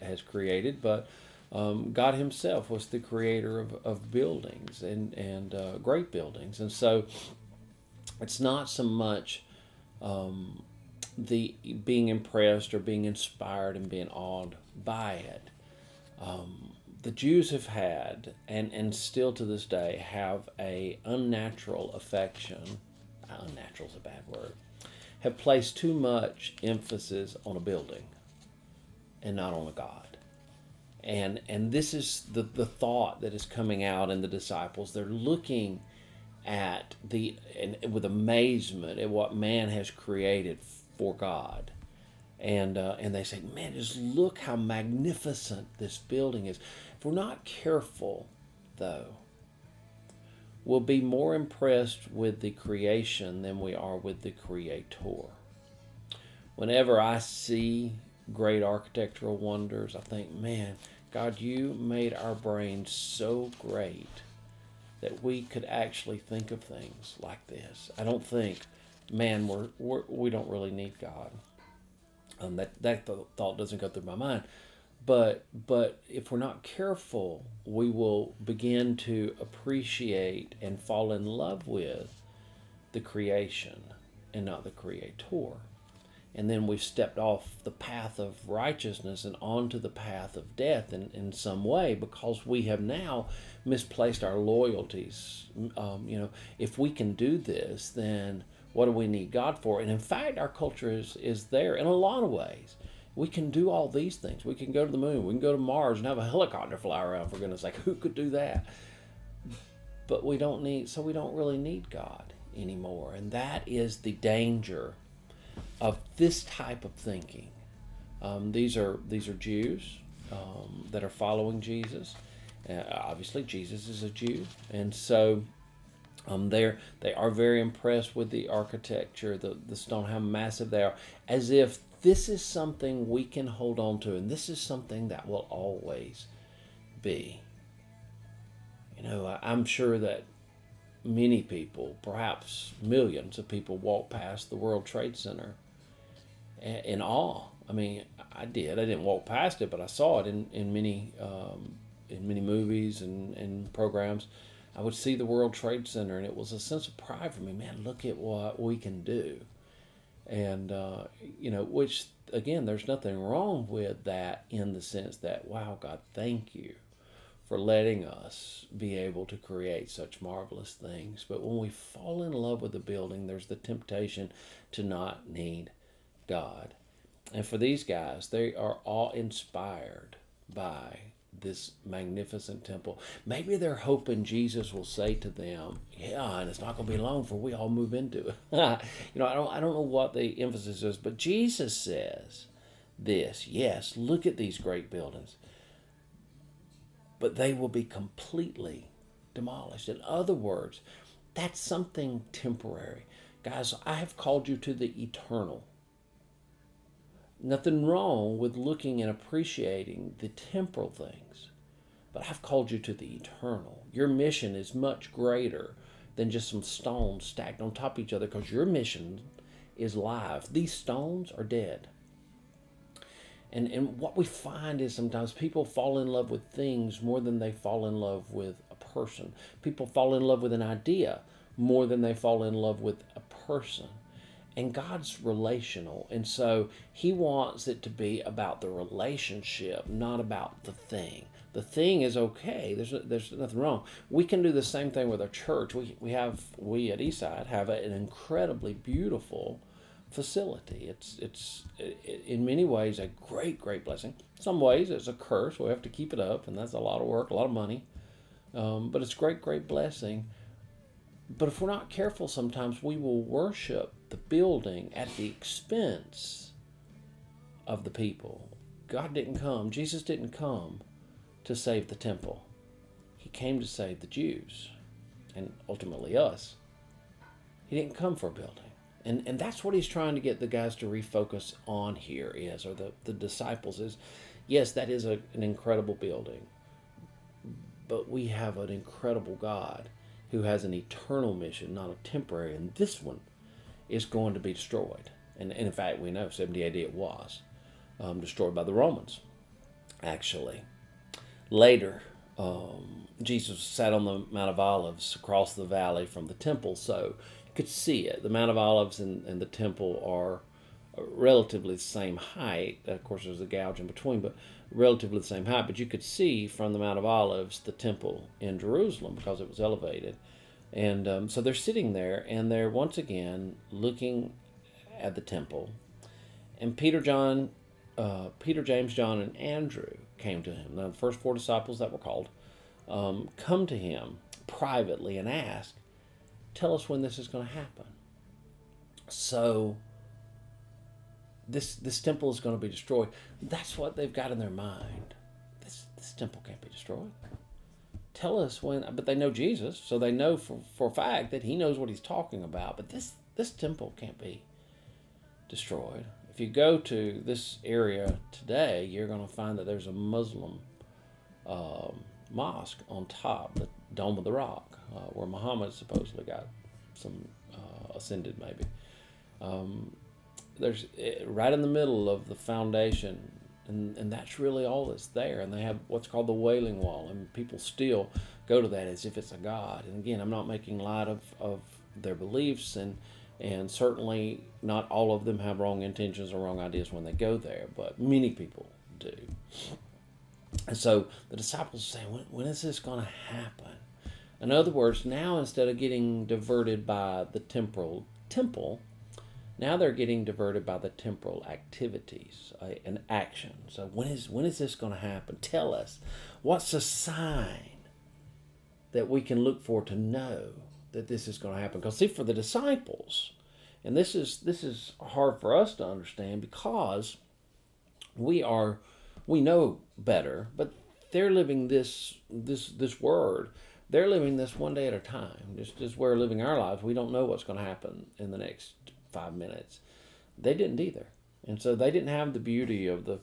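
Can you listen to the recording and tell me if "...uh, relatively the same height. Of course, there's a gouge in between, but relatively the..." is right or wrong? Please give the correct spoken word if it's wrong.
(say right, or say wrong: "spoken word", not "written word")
right.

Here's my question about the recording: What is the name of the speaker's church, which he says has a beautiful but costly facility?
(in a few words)
Eastside.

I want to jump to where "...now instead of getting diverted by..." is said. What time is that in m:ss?
6:35.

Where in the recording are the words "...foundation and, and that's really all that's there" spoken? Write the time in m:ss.
6:12.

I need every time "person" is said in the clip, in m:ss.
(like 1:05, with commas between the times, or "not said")
3:48, 3:53.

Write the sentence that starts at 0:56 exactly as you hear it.
Whenever I see great architectural wonders.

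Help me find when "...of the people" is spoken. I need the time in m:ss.
4:27.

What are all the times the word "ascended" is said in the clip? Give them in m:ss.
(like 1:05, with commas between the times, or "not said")
6:07.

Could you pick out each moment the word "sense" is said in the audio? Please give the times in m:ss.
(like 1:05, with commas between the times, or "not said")
2:36, 2:44.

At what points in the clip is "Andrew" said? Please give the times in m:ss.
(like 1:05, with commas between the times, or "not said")
5:29.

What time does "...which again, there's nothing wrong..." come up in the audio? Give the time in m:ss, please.
2:41.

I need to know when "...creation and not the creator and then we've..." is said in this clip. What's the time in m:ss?
1:23.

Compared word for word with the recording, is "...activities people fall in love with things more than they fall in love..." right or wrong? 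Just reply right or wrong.
wrong.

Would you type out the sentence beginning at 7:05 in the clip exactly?
Just as we're living our lives, we don't know what's going to happen in the next five minutes.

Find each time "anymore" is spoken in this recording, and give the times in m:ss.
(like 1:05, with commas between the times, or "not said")
1:52.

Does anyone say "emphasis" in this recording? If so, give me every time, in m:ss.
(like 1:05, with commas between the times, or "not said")
0:26, 3:10.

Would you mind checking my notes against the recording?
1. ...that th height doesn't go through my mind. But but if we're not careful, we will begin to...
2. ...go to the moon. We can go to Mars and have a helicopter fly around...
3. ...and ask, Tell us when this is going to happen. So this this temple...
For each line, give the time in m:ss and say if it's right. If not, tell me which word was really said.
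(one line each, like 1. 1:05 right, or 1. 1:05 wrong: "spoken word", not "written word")
1. 1:12 wrong: "thought", not "height"
2. 1:44 right
3. 5:35 right.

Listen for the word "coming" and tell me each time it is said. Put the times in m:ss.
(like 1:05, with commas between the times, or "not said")
0:33.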